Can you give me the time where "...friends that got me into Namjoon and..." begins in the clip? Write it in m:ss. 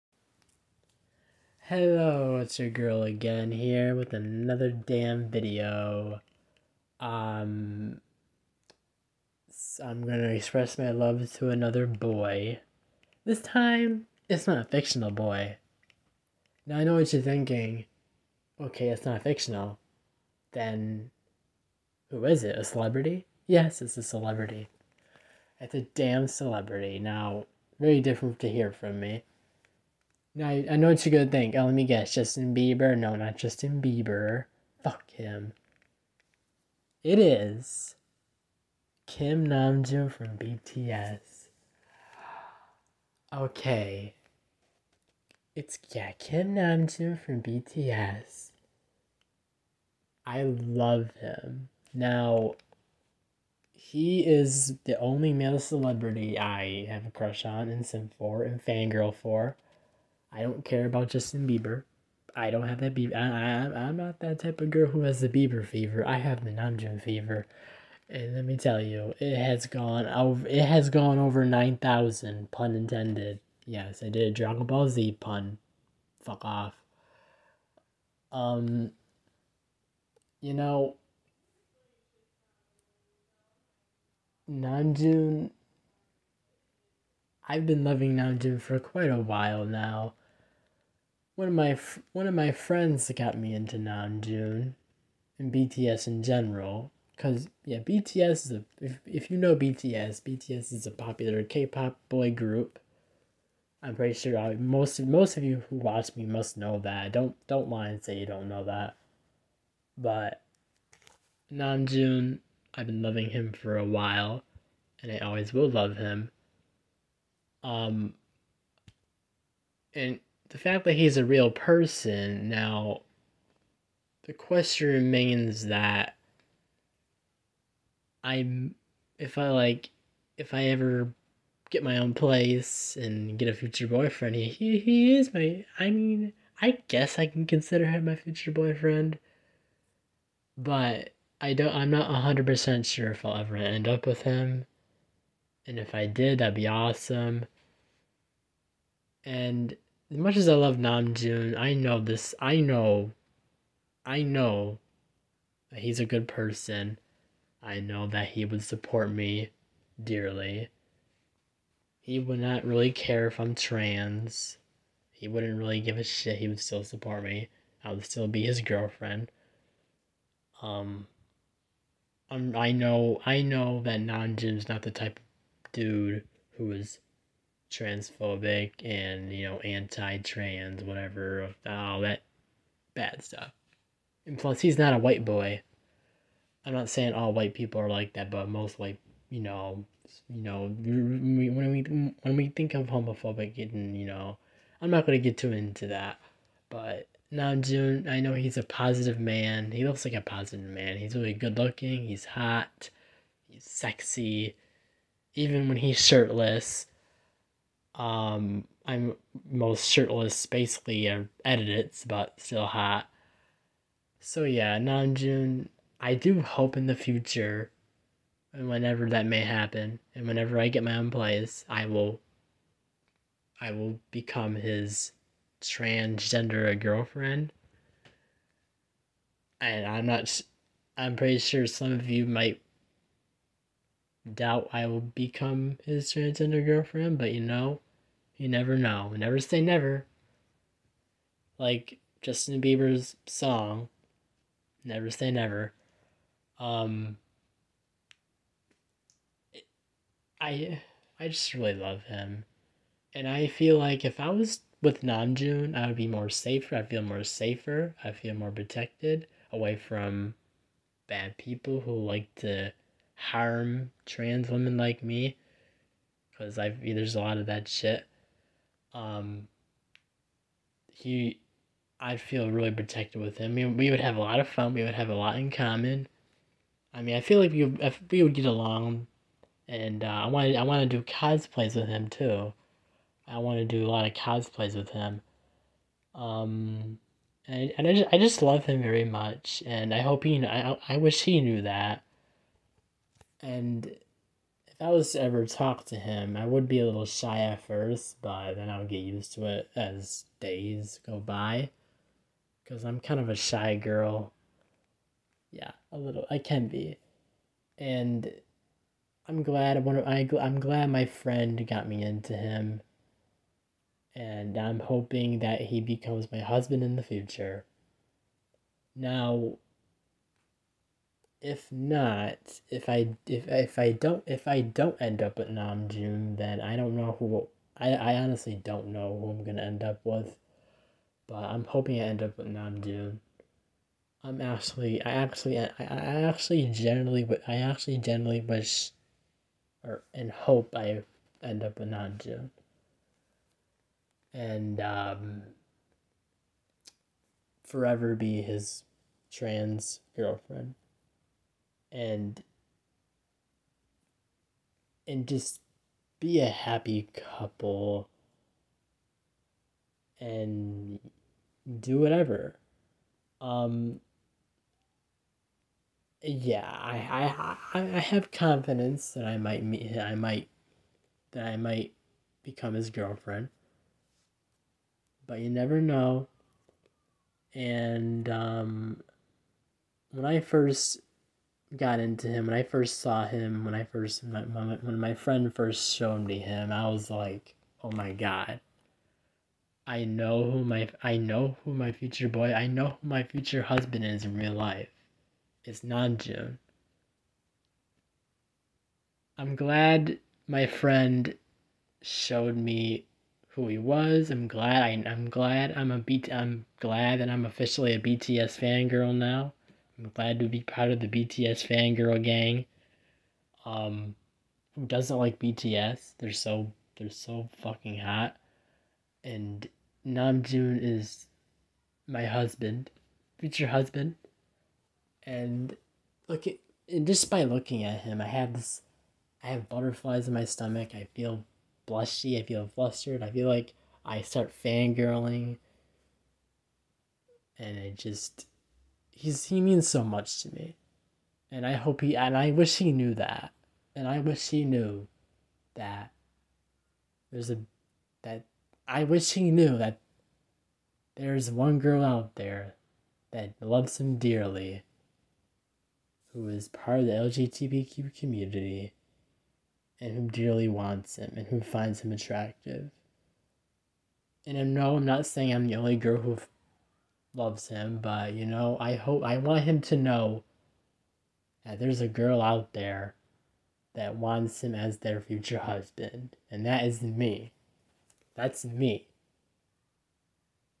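1:32.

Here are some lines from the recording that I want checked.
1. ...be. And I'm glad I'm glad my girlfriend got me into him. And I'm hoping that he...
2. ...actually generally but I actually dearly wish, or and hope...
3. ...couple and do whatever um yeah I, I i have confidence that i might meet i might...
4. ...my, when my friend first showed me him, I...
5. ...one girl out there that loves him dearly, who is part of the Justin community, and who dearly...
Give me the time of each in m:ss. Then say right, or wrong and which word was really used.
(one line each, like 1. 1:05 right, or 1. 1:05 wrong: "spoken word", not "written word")
1. 5:06 wrong: "friend", not "girlfriend"
2. 5:36 wrong: "generally", not "dearly"
3. 5:57 right
4. 6:24 right
5. 7:31 wrong: "LGBTQ", not "Justin".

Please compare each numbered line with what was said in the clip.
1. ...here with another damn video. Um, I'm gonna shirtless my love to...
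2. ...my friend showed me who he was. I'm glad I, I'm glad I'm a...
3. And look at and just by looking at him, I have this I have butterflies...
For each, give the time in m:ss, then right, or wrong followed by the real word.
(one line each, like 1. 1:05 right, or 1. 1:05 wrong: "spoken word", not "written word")
1. 0:03 wrong: "express", not "shirtless"
2. 6:40 right
3. 7:05 right.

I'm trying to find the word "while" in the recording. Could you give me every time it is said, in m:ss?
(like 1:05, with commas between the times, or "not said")
1:29, 1:53.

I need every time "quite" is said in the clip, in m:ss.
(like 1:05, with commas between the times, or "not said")
1:28.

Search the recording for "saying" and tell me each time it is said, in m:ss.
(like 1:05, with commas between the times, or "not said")
3:06, 7:45.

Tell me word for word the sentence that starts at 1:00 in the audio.
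I don't care about Justin Bieber.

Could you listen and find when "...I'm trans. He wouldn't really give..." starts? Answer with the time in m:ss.
2:43.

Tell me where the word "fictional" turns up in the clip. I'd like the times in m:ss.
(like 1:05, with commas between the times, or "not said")
0:14, 0:19.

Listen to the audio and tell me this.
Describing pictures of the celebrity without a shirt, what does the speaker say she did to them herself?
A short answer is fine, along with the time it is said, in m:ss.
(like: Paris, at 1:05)
edited, at 3:31.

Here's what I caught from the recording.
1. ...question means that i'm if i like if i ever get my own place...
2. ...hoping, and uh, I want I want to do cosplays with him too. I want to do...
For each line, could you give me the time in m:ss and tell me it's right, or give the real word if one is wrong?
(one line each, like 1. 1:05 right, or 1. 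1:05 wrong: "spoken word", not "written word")
1. 2:04 wrong: "remains", not "means"
2. 4:38 wrong: "along", not "hoping".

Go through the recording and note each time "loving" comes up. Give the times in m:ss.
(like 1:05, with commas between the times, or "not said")
1:27, 1:53.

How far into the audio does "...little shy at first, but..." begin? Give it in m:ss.
4:56.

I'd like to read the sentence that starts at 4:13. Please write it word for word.
And I feel like if I was with Namjoon, I would be more safer.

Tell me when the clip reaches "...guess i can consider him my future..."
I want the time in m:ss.
2:16.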